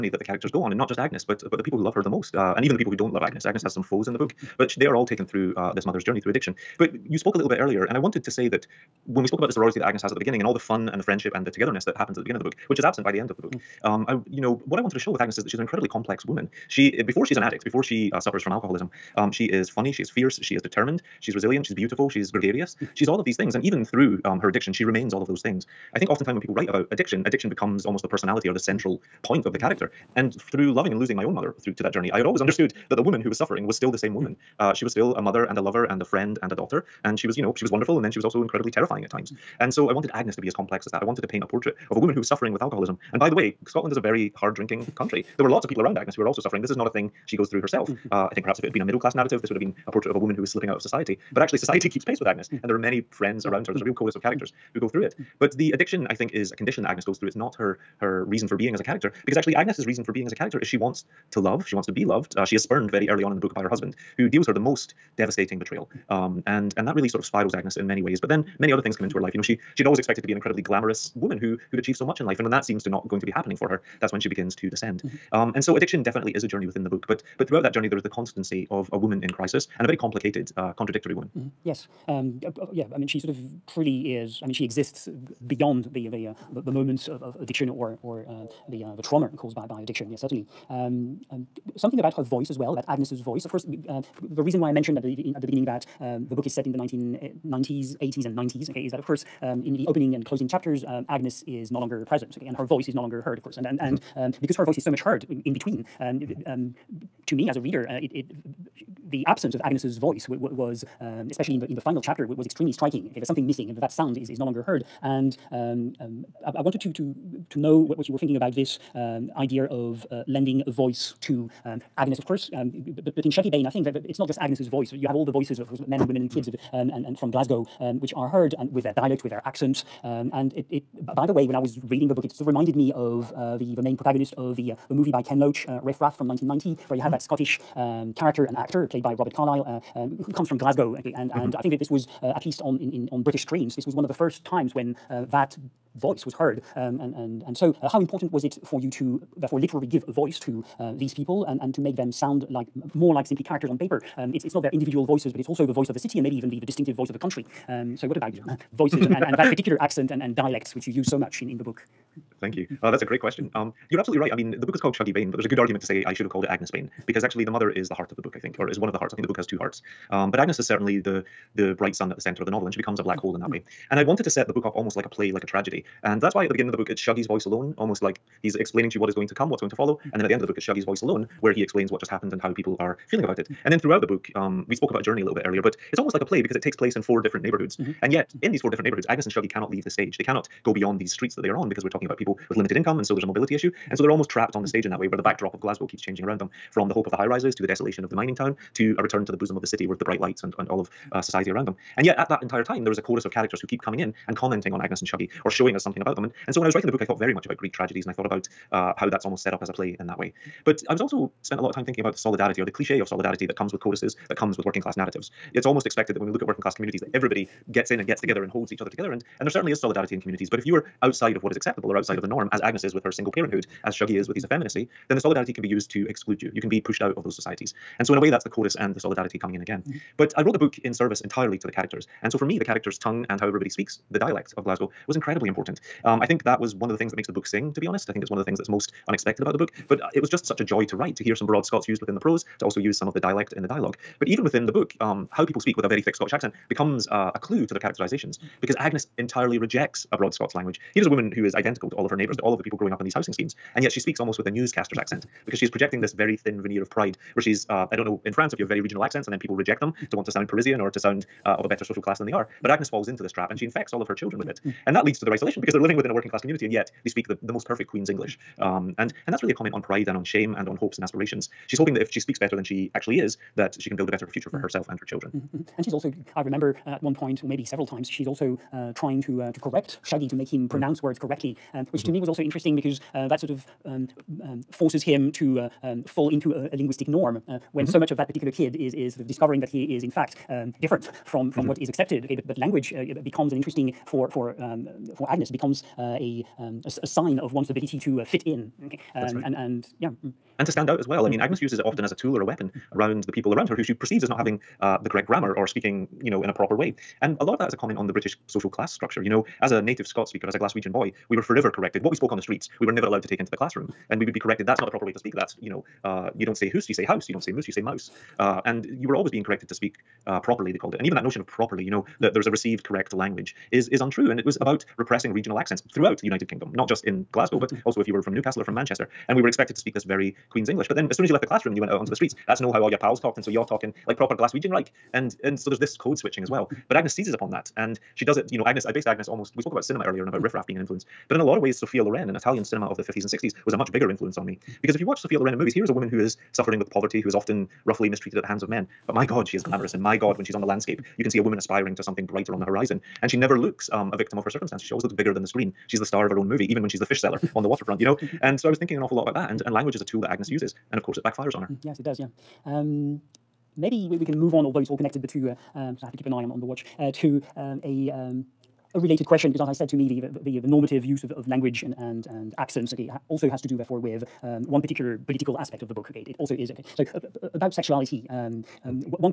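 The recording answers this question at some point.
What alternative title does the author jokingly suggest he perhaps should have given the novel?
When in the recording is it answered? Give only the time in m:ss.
2:46.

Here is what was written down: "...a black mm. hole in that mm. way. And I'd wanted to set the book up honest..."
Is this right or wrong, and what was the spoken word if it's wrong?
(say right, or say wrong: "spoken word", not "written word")
wrong: "almost", not "honest".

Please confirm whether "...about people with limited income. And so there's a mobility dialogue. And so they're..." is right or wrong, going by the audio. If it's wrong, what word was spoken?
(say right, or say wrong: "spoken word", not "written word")
wrong: "issue", not "dialogue".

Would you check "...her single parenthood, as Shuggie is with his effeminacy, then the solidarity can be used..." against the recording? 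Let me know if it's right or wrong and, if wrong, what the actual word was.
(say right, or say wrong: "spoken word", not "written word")
right.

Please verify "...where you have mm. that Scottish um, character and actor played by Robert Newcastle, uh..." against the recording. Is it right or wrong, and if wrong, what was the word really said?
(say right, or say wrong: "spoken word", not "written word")
wrong: "Carlyle", not "Newcastle".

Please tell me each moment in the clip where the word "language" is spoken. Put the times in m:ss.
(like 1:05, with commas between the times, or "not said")
4:10, 4:52, 5:23, 5:59, 6:11.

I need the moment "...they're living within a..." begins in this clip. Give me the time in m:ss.
4:25.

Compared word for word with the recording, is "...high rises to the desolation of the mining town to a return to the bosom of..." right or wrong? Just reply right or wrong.
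right.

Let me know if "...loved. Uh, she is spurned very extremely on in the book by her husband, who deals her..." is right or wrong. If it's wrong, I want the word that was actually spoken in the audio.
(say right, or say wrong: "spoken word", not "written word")
wrong: "early", not "extremely".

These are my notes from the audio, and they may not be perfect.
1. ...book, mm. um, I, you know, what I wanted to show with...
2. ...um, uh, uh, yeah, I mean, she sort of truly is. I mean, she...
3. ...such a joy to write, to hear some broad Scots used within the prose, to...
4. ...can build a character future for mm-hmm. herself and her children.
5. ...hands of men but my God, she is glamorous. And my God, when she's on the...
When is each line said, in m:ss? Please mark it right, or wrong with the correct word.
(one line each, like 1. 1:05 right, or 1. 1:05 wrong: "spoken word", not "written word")
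1. 0:13 right
2. 1:22 right
3. 4:00 right
4. 4:33 wrong: "better", not "character"
5. 5:48 right.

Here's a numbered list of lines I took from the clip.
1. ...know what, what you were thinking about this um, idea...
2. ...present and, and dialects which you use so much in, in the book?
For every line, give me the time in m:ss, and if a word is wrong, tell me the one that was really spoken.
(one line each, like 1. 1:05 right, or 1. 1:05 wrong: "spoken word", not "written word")
1. 1:57 right
2. 2:39 wrong: "accent", not "present".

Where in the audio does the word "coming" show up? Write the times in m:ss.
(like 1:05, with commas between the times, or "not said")
3:23, 3:49.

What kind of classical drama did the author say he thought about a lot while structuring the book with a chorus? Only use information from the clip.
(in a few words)
Greek tragedies.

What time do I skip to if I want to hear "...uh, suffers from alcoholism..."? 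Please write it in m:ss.
0:18.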